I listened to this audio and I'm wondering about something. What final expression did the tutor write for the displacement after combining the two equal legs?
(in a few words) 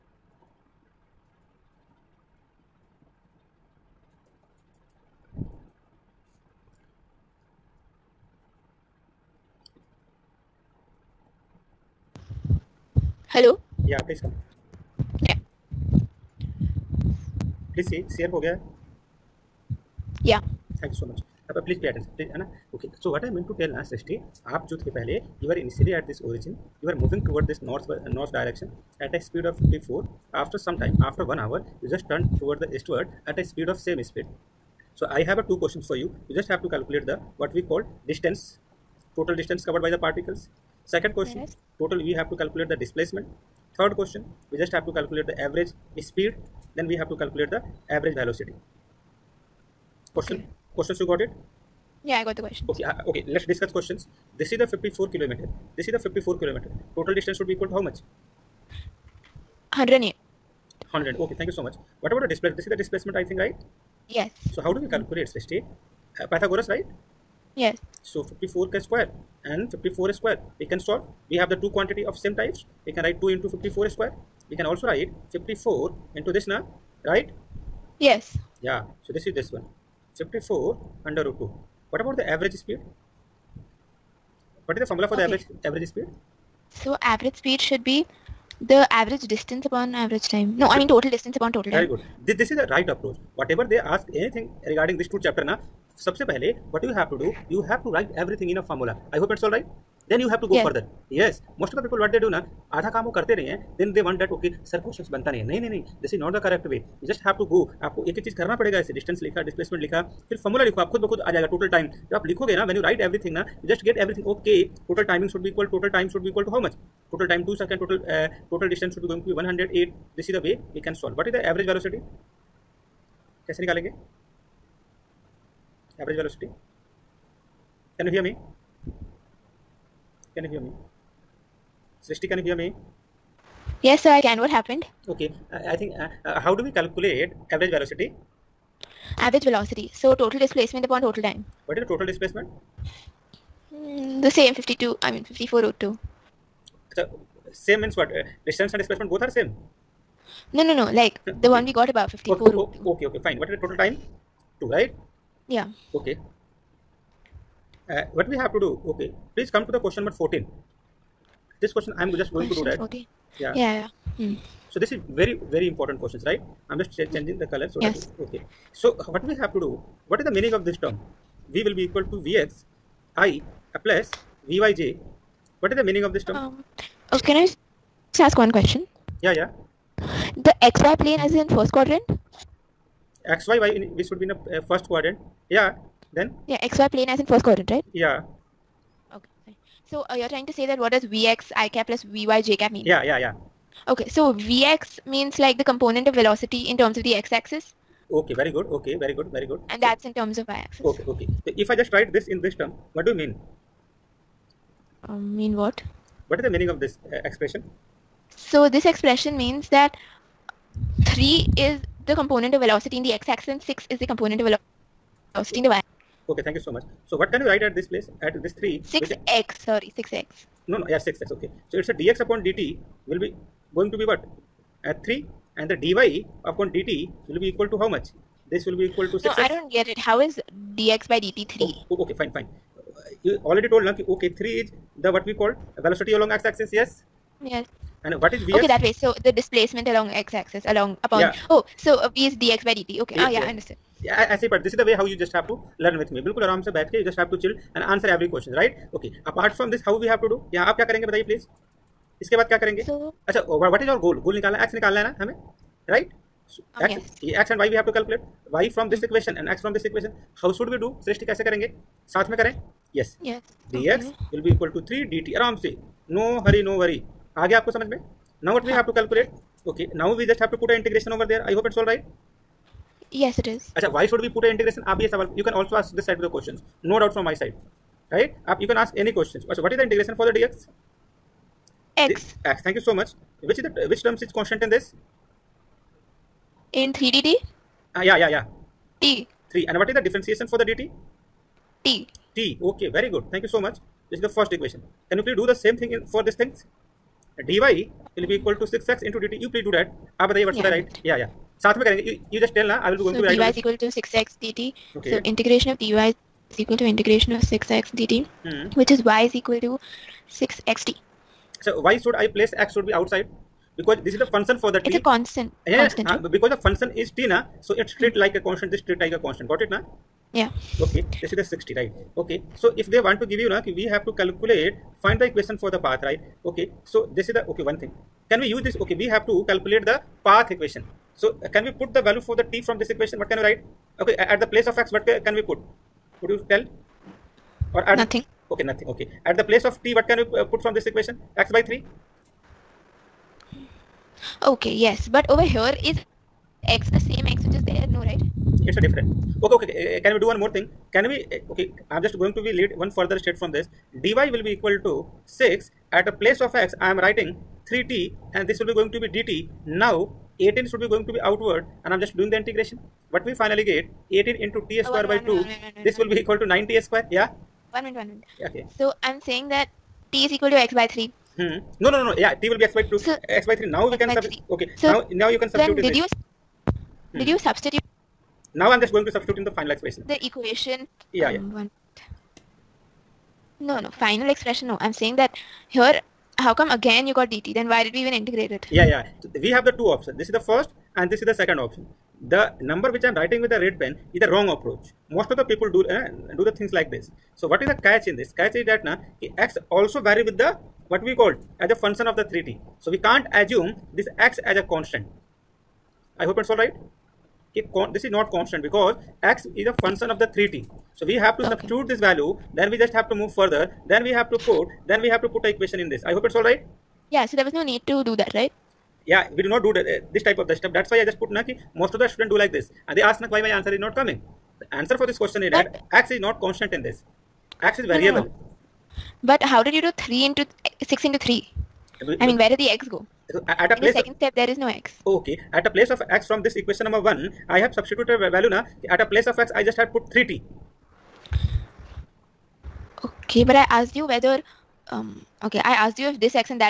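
54 root 2.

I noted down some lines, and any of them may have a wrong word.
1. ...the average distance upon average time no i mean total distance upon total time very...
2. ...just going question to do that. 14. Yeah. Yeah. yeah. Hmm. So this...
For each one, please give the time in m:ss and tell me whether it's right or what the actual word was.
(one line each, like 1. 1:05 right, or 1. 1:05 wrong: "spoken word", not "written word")
1. 1:28 right
2. 2:42 right.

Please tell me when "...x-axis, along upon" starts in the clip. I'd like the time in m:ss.
4:00.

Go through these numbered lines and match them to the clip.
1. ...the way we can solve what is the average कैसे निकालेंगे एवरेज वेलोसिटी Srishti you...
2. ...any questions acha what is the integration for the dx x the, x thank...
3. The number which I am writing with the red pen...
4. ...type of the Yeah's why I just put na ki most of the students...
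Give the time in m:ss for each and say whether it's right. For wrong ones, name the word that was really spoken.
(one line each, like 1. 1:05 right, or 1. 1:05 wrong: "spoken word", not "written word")
1. 2:00 wrong: "Can", not "Srishti"
2. 4:39 right
3. 6:32 right
4. 7:00 wrong: "That", not "Yeah".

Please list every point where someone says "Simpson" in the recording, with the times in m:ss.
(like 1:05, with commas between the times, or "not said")
not said.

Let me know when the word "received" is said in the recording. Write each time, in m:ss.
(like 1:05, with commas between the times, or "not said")
not said.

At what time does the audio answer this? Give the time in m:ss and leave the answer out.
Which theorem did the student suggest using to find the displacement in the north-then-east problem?
1:06.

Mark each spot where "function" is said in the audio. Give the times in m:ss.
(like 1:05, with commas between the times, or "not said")
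6:41, 6:49.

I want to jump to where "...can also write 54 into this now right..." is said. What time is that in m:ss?
1:14.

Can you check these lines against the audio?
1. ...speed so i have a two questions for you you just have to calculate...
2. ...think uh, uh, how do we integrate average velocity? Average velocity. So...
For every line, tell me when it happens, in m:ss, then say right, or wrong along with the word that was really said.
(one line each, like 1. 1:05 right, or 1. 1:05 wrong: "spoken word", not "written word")
1. 0:34 right
2. 2:15 wrong: "calculate", not "integrate".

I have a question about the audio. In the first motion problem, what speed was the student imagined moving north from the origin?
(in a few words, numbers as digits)
54.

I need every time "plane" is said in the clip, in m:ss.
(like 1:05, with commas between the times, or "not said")
3:00, 3:06.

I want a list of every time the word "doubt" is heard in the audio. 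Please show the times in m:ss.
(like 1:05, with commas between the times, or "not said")
4:37.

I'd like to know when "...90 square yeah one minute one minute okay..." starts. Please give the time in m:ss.
6:06.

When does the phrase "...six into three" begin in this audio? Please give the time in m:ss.
7:10.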